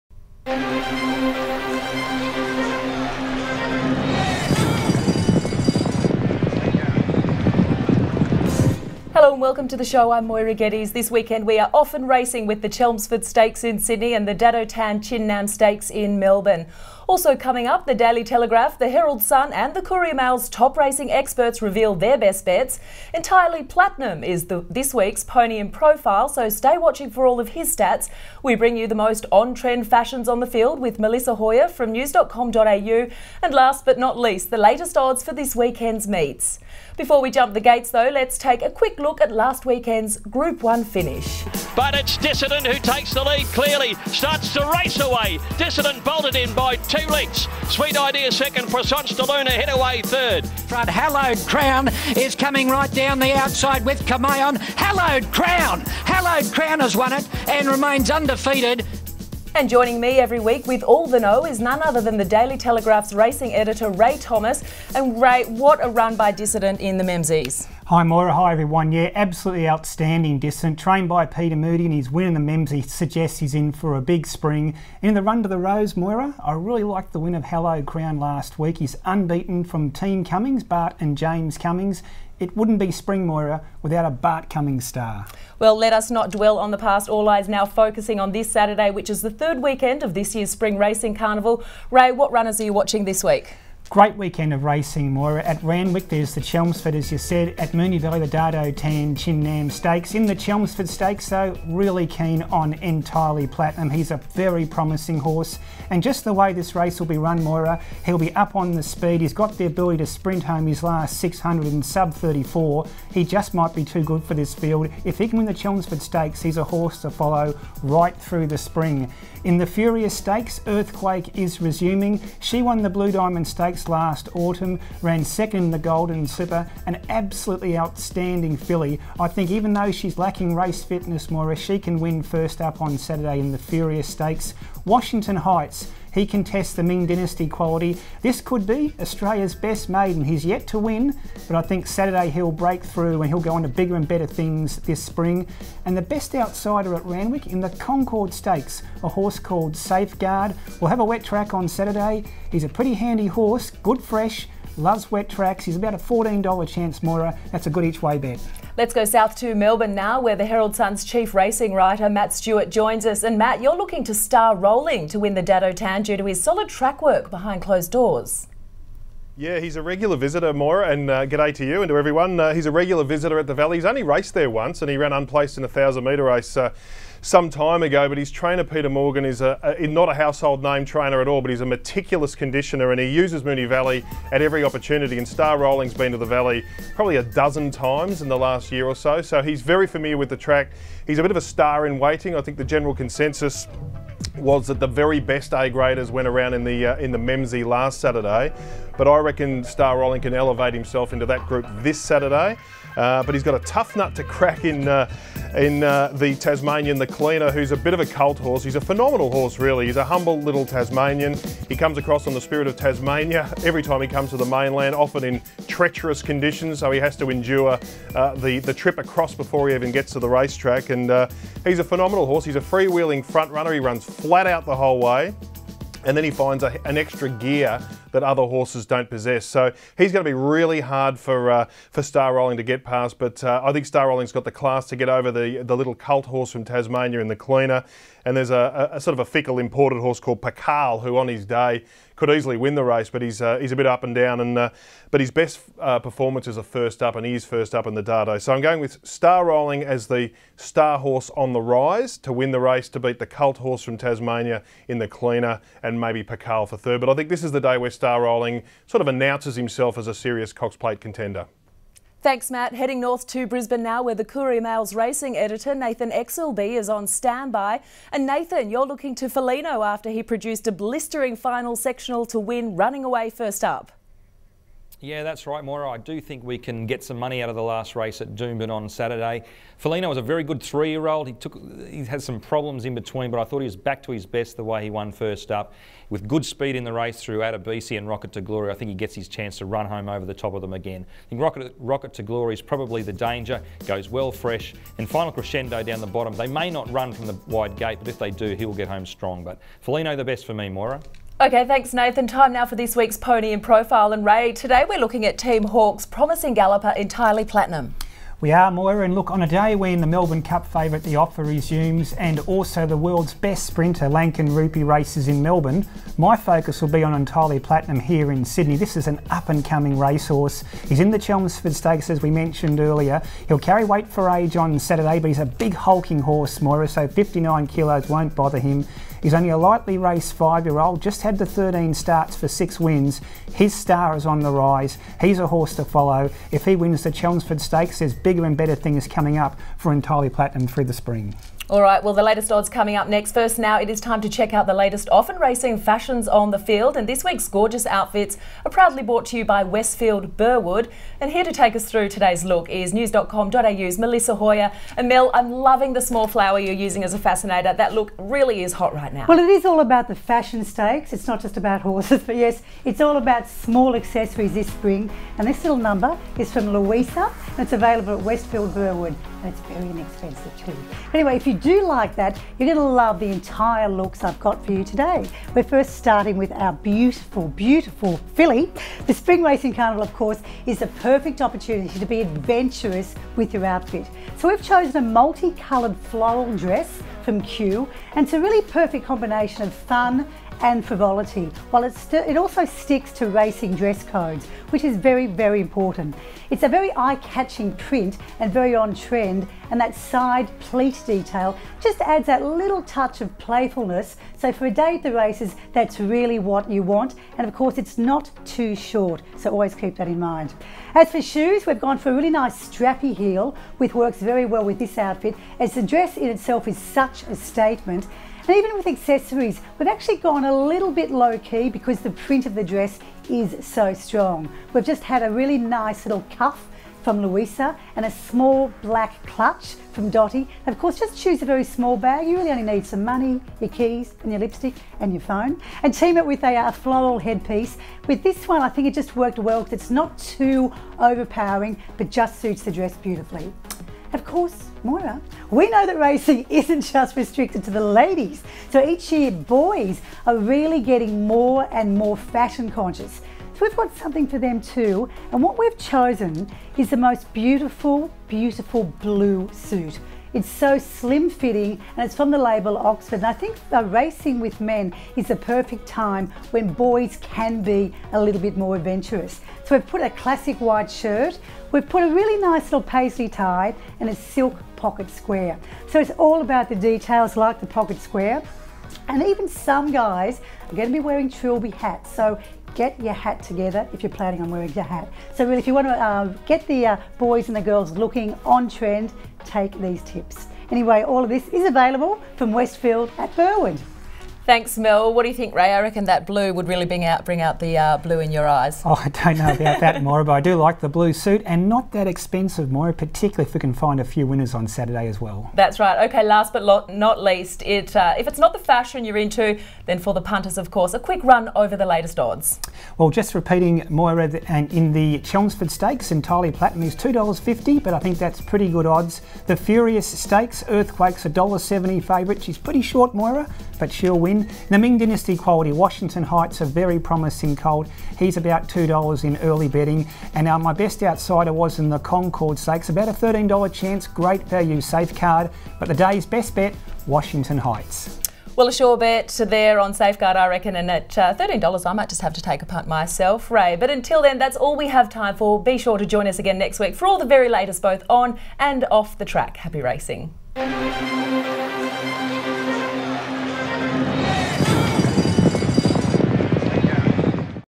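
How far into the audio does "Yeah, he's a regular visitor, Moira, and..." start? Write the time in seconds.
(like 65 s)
169 s.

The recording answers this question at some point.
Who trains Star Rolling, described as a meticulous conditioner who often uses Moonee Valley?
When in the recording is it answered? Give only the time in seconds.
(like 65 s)
178 s.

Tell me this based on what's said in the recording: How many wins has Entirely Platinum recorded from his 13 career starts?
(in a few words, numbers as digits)
6.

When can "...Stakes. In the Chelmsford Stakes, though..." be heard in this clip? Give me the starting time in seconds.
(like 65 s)
99 s.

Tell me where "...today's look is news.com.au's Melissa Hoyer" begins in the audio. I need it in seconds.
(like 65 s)
352 s.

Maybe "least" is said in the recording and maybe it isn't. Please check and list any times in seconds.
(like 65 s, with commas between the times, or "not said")
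34 s, 507 s.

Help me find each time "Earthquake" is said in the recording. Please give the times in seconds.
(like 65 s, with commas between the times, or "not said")
120 s, 520 s.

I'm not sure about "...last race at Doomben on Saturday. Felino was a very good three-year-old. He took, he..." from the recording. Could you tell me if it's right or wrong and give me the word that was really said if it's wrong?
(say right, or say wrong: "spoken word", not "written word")
right.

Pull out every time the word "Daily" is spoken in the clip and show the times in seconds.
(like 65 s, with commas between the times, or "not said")
17 s, 62 s.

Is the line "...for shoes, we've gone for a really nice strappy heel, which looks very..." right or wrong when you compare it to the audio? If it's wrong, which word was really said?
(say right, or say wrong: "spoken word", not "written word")
wrong: "works", not "looks".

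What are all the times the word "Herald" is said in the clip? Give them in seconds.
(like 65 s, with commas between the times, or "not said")
18 s, 160 s.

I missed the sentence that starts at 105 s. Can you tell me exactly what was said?
And just the way this race will be run, Moira, he'll be up on the speed.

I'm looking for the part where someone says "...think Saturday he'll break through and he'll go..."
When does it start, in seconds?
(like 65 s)
141 s.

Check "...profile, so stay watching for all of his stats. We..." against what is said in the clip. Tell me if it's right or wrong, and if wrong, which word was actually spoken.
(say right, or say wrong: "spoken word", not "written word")
right.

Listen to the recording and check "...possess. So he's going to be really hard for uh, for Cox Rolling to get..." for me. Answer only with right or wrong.
wrong.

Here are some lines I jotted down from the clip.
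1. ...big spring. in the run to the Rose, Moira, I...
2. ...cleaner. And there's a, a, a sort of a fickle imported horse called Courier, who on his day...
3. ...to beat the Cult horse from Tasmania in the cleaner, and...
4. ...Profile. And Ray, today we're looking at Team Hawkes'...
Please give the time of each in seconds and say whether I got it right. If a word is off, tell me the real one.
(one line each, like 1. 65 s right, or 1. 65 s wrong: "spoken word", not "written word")
1. 74 s right
2. 237 s wrong: "Pakal", not "Courier"
3. 252 s right
4. 303 s right.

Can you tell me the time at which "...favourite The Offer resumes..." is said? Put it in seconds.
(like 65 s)
310 s.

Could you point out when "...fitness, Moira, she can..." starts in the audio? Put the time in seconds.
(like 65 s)
130 s.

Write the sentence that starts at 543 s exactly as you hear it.
But until then, that's all we have time for.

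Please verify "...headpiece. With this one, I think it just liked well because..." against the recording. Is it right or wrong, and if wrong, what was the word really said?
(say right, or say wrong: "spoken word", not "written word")
wrong: "worked", not "liked".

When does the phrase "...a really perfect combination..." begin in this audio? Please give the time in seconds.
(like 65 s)
388 s.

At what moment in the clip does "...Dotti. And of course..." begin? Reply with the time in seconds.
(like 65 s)
430 s.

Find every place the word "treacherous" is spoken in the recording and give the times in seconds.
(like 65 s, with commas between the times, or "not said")
215 s.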